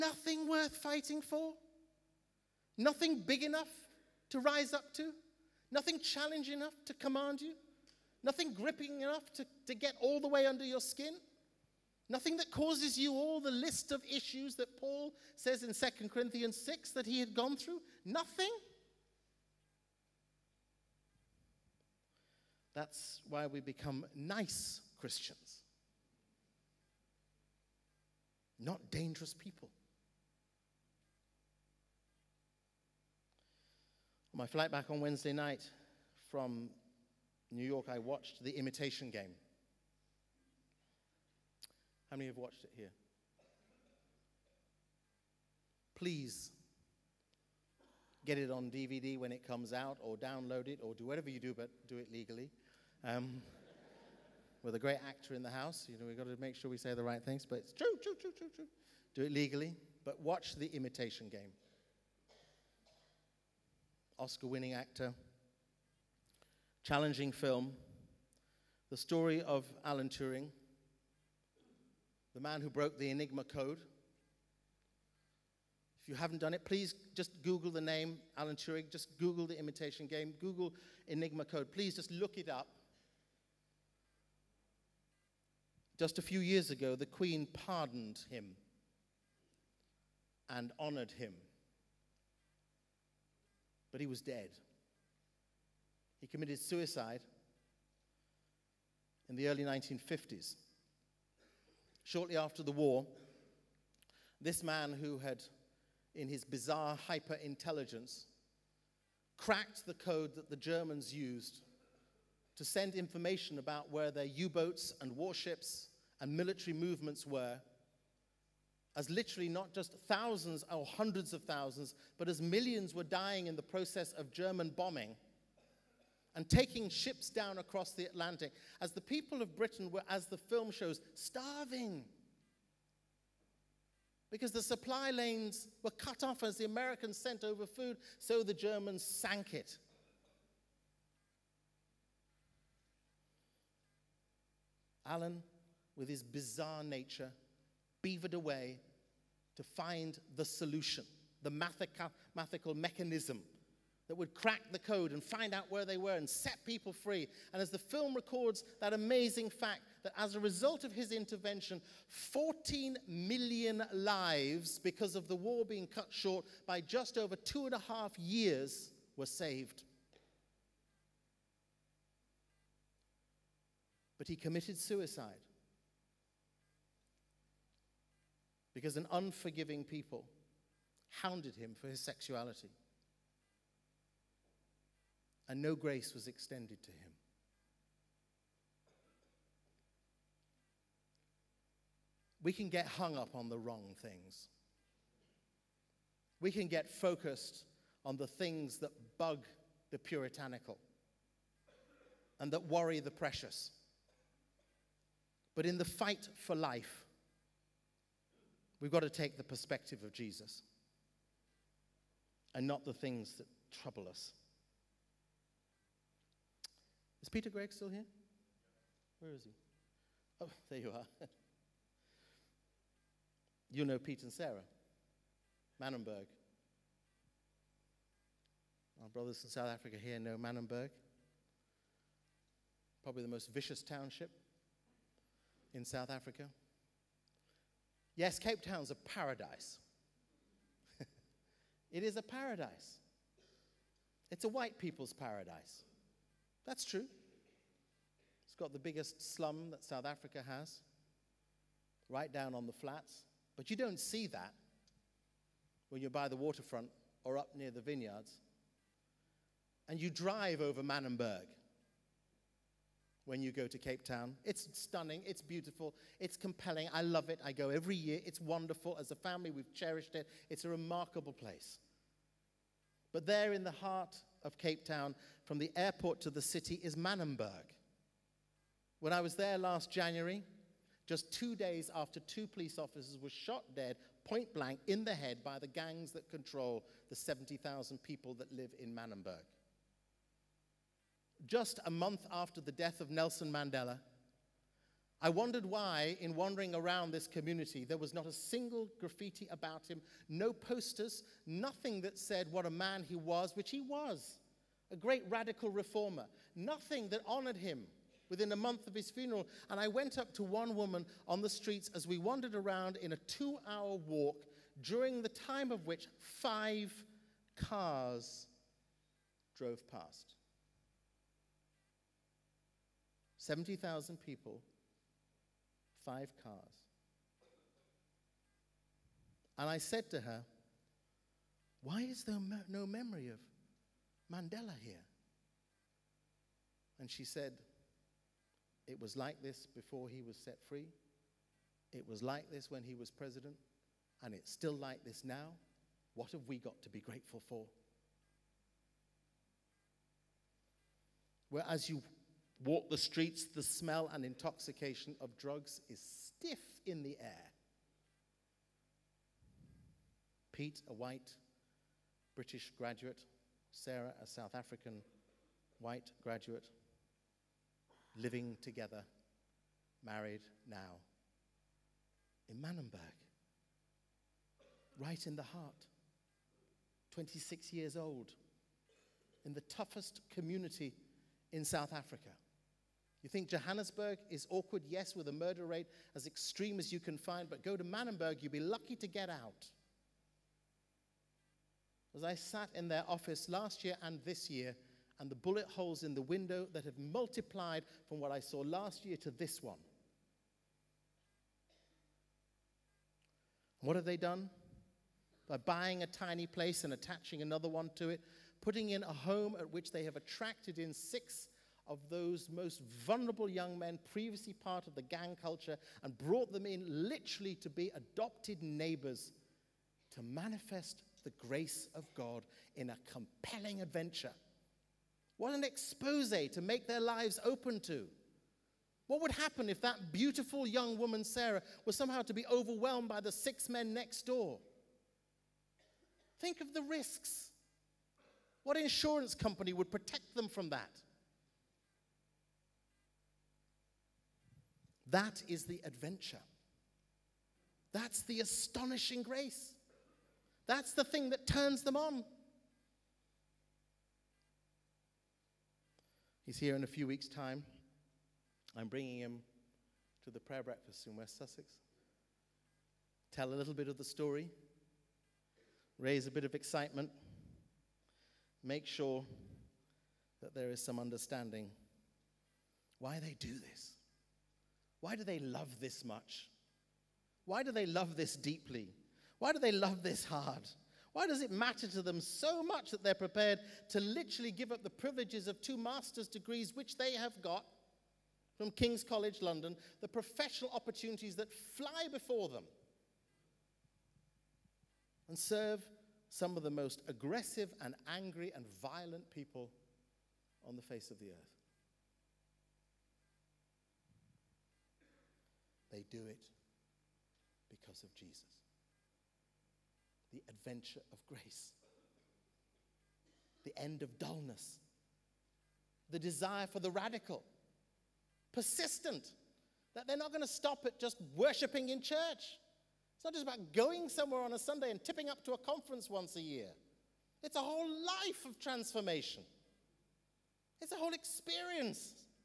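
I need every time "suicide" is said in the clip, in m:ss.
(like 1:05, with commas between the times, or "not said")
1:36, 2:54.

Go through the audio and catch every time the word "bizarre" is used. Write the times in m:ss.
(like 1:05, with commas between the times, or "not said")
1:46, 2:26.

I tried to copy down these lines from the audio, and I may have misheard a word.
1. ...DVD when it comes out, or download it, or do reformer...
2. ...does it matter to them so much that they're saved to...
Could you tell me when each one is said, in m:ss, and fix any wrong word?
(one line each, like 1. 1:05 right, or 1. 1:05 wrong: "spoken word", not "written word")
1. 0:48 wrong: "whatever", not "reformer"
2. 8:01 wrong: "prepared", not "saved".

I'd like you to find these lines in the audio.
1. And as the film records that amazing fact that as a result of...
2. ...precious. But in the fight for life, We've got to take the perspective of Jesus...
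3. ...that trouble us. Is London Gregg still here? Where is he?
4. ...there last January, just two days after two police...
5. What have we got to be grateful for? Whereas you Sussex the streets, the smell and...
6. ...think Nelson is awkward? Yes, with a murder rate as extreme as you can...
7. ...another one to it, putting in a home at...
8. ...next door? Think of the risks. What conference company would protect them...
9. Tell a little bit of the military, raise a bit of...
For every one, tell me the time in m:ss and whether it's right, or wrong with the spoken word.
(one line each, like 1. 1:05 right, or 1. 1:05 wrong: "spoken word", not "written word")
1. 2:37 right
2. 3:23 right
3. 3:33 wrong: "Peter", not "London"
4. 4:39 right
5. 5:46 wrong: "Walk", not "Sussex"
6. 6:23 wrong: "Johannesburg", not "Nelson"
7. 6:47 right
8. 7:13 wrong: "insurance", not "conference"
9. 7:43 wrong: "story", not "military".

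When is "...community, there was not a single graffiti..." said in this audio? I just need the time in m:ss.
4:57.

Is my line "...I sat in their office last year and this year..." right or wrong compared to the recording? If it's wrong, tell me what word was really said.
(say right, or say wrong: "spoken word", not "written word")
right.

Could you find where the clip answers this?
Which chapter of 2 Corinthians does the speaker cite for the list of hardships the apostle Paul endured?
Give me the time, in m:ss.
0:15.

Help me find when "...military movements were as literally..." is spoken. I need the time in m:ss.
1:56.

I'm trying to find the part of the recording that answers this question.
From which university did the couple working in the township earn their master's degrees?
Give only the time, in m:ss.
8:08.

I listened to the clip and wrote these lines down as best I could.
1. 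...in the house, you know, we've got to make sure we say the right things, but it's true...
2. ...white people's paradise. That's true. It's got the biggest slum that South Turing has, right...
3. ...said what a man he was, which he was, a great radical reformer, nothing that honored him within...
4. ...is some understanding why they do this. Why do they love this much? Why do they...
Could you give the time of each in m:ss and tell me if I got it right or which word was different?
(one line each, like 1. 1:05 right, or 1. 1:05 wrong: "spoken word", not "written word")
1. 0:55 right
2. 4:04 wrong: "Africa", not "Turing"
3. 5:02 right
4. 7:50 right.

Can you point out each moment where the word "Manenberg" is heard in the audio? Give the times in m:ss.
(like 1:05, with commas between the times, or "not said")
3:45, 3:50, 4:20, 4:36, 4:48, 6:12, 6:27.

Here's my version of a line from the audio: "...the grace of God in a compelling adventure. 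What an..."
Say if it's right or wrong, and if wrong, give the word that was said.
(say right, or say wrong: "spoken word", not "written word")
right.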